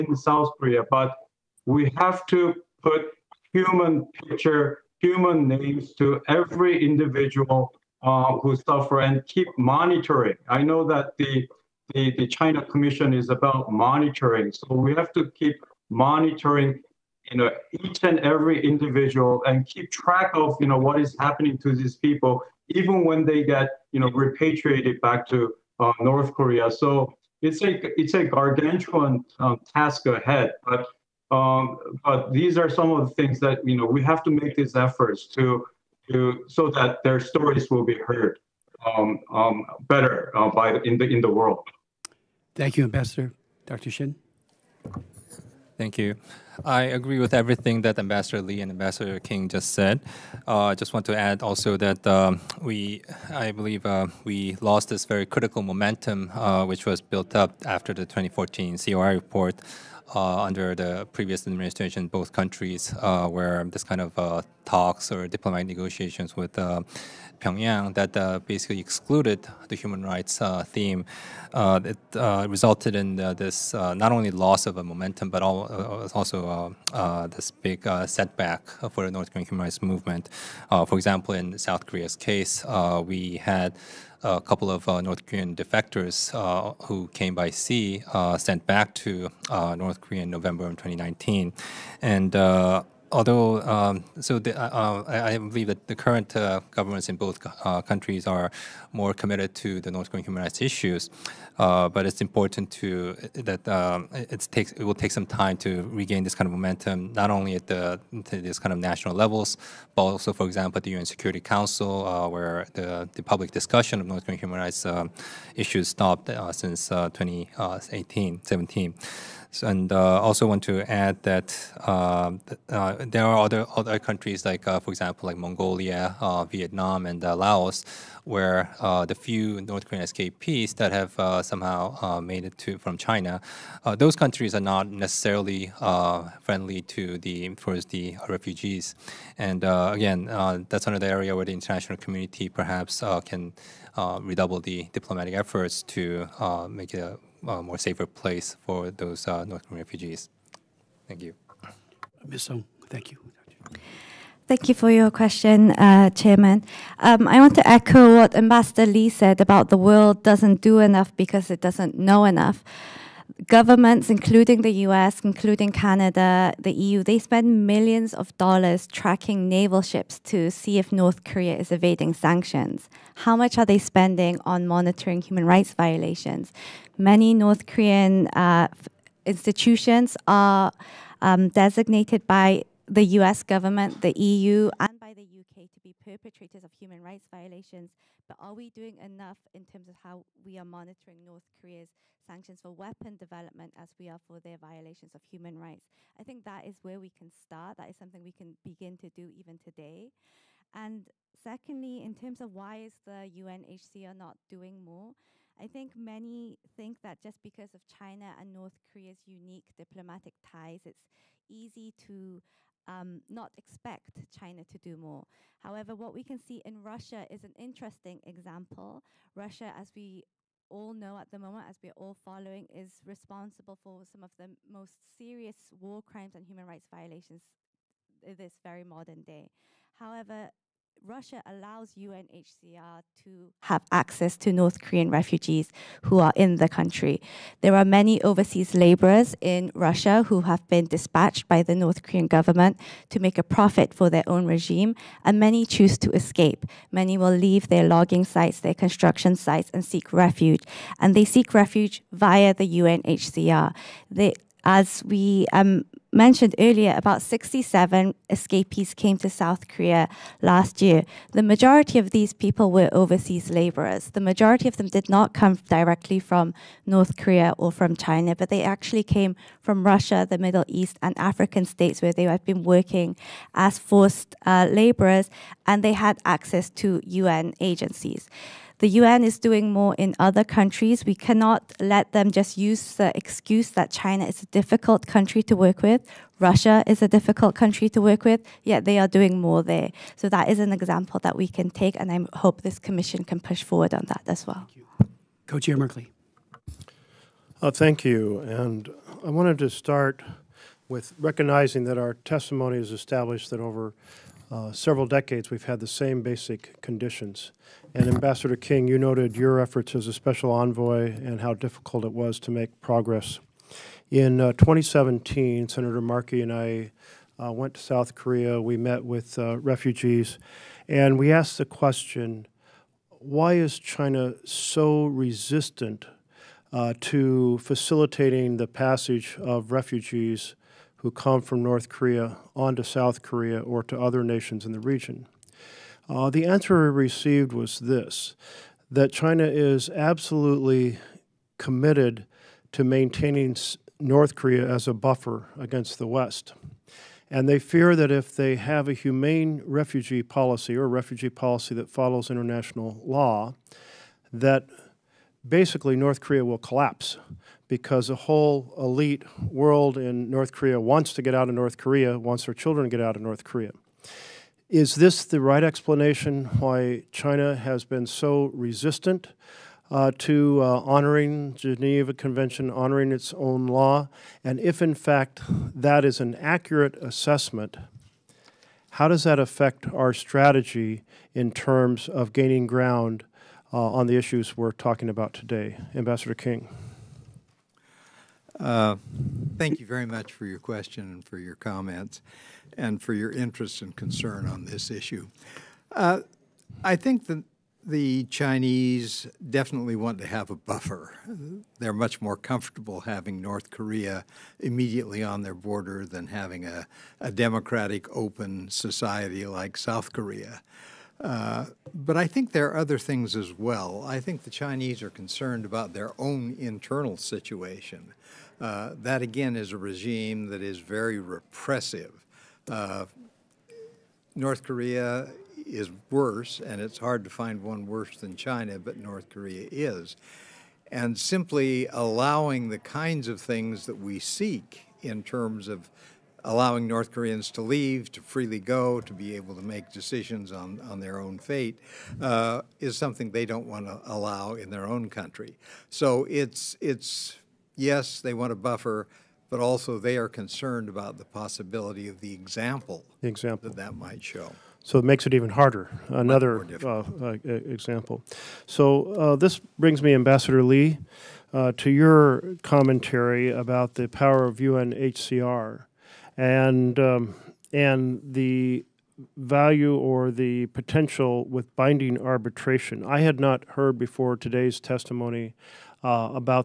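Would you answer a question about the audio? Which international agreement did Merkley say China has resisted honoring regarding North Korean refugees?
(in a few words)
Geneva Convention.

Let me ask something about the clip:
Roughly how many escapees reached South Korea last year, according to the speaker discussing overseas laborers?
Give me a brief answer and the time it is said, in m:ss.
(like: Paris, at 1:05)
67, at 4:17.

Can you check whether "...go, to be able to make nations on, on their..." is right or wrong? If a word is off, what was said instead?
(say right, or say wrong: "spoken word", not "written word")
wrong: "decisions", not "nations".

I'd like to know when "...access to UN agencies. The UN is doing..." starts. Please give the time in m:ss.
4:36.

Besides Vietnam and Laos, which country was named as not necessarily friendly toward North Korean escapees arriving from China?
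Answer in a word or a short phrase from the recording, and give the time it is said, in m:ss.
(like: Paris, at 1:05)
Mongolia, at 2:05.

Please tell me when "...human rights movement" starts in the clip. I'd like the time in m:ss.
1:19.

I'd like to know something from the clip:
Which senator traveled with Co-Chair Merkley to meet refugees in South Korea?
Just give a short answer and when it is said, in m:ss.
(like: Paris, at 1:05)
Senator Markey, at 5:15.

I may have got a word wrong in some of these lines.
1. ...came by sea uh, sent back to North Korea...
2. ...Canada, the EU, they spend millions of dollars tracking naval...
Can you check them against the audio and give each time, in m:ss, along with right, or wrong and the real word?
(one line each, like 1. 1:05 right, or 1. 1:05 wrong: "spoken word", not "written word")
1. 1:27 right
2. 2:45 right.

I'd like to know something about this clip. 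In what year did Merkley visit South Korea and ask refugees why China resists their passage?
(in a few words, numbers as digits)
2017.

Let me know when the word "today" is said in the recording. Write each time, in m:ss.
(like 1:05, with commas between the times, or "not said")
3:19, 6:25, 7:54.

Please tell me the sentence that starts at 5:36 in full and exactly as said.
Uh, the answer I received was this that China is absolutely committed to maintaining North Korea as a buffer against the West.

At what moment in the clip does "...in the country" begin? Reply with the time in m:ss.
3:56.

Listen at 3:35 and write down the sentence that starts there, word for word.
However, what we can see in Russia is an interesting example.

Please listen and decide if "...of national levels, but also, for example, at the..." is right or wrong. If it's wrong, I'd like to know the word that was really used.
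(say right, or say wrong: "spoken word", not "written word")
right.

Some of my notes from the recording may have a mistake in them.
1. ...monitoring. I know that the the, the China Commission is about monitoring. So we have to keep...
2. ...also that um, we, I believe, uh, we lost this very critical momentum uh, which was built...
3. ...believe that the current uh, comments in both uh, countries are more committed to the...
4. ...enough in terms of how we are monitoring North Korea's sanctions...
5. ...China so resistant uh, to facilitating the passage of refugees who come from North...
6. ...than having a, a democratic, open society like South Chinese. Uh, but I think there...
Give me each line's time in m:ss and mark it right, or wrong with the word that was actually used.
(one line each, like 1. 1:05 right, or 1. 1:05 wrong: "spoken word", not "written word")
1. 0:09 right
2. 0:51 right
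3. 1:35 wrong: "governments", not "comments"
4. 3:08 right
5. 5:23 right
6. 6:46 wrong: "Korea", not "Chinese".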